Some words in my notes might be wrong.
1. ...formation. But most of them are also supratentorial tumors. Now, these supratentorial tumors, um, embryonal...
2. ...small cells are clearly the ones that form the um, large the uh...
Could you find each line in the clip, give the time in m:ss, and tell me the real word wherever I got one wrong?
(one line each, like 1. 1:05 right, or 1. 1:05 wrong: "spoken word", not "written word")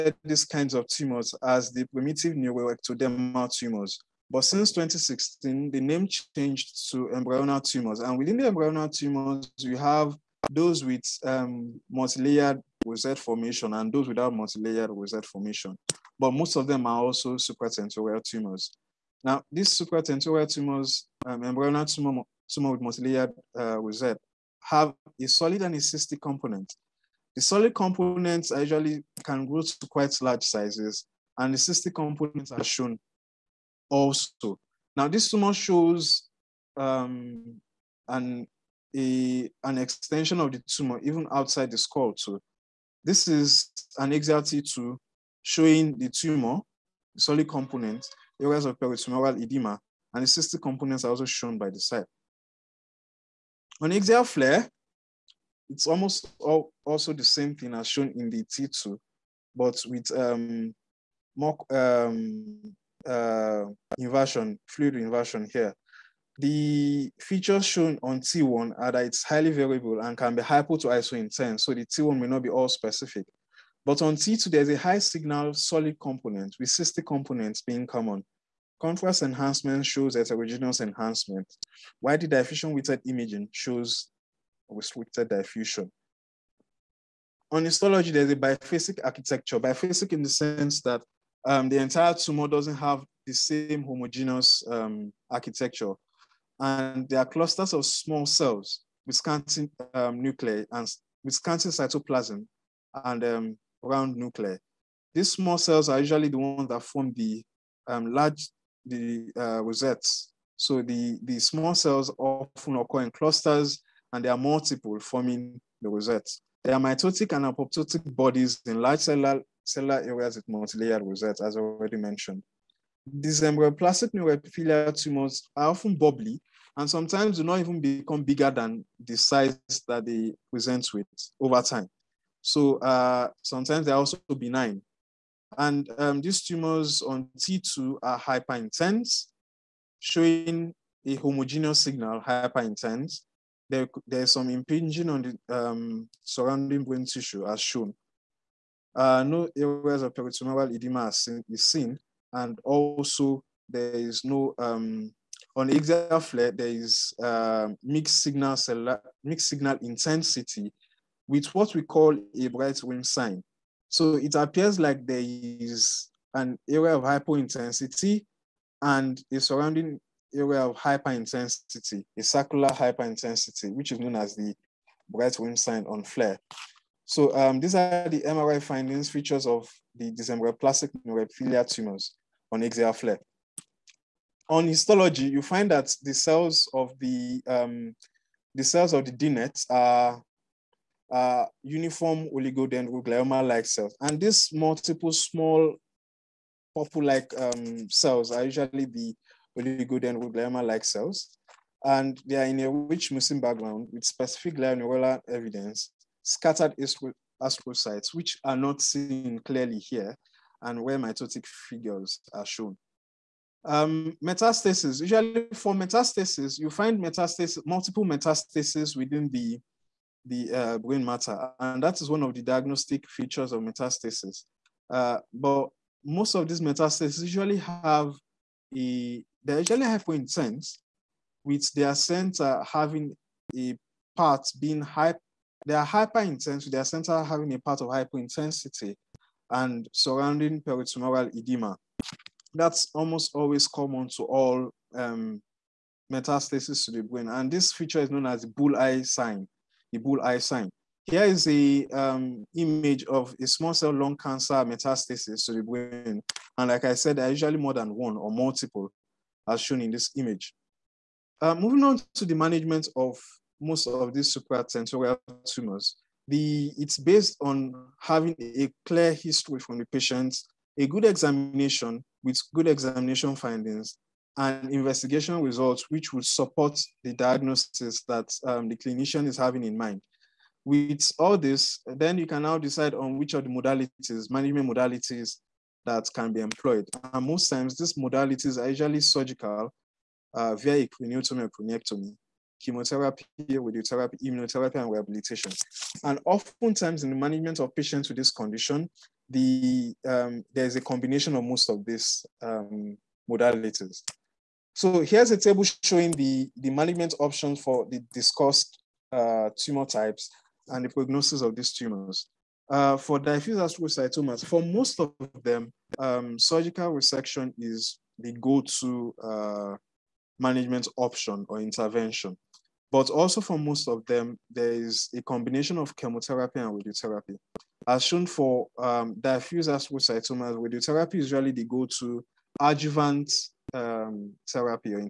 1. 0:15 right
2. 1:45 wrong: "usually", not "clearly".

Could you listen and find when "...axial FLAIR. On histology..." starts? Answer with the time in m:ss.
3:02.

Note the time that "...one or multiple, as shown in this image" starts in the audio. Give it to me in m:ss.
4:17.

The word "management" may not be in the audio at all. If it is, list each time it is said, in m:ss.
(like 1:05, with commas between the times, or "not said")
4:22, 4:44, 4:57, 5:06, 5:20.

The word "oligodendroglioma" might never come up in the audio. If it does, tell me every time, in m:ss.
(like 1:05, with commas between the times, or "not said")
3:12, 3:19.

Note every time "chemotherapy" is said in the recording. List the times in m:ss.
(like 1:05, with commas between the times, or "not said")
4:52, 5:25.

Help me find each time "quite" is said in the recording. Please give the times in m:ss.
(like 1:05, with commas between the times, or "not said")
0:29.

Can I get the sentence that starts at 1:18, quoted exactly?
Contrast enhancement shows heterogeneous enhancement, while the diffusion weighted imaging shows restricted diffusion.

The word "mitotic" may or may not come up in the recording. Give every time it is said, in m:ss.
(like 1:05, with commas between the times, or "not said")
1:56, 3:30.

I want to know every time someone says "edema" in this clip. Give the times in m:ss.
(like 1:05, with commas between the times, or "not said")
0:49, 2:30, 4:01.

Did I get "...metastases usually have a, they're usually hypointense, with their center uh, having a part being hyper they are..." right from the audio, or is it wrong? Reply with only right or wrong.
right.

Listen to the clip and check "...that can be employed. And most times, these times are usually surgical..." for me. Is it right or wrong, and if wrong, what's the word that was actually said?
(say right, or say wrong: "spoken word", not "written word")
wrong: "modalities", not "times".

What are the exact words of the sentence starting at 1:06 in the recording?
The features shown on T1 are that it's highly variable and can be hypo to iso intense.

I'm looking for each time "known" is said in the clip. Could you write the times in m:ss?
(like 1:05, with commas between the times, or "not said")
2:54, 4:08.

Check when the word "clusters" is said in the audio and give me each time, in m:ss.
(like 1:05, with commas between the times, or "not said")
1:37, 1:53.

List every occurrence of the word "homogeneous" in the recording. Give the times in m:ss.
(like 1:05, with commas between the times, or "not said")
1:33, 2:21.